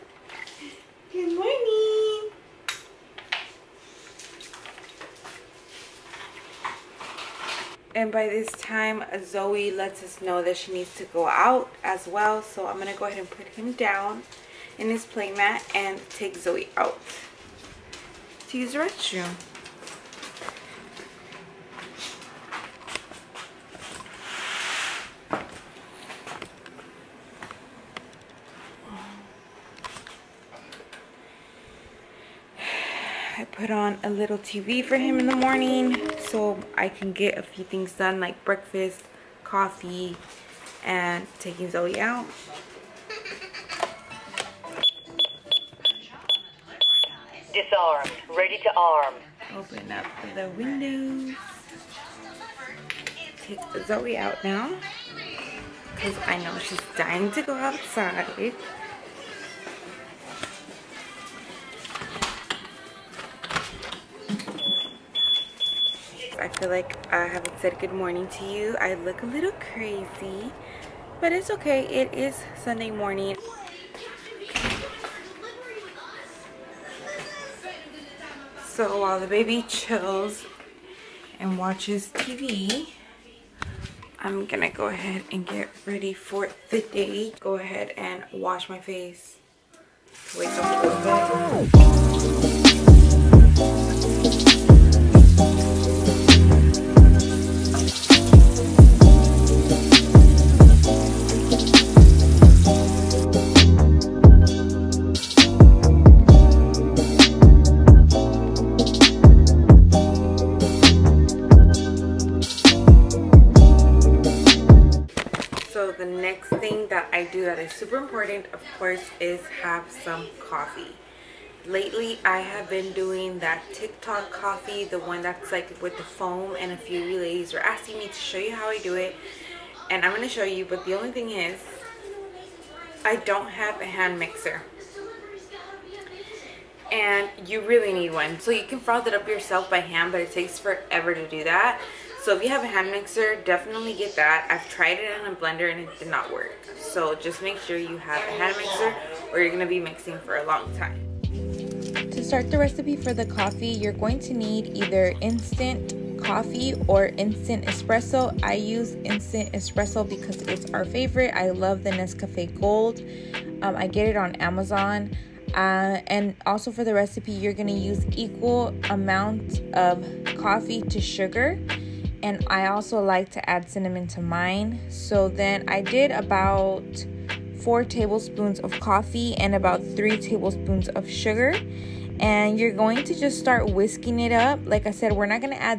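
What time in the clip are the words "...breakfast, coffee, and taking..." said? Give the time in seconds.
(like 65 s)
38 s.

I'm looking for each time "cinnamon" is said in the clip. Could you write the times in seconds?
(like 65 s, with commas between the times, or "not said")
173 s.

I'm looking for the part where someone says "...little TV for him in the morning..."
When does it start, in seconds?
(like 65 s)
34 s.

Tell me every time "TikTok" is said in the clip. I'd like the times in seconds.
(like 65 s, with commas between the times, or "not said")
123 s.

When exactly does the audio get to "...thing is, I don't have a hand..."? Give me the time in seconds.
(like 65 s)
131 s.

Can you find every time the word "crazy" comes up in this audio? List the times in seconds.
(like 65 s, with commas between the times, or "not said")
69 s.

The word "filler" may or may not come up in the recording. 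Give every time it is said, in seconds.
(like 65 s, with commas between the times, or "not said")
not said.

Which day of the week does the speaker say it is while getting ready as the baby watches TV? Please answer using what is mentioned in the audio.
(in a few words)
Sunday.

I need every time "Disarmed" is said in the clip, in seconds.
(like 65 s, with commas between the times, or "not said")
47 s.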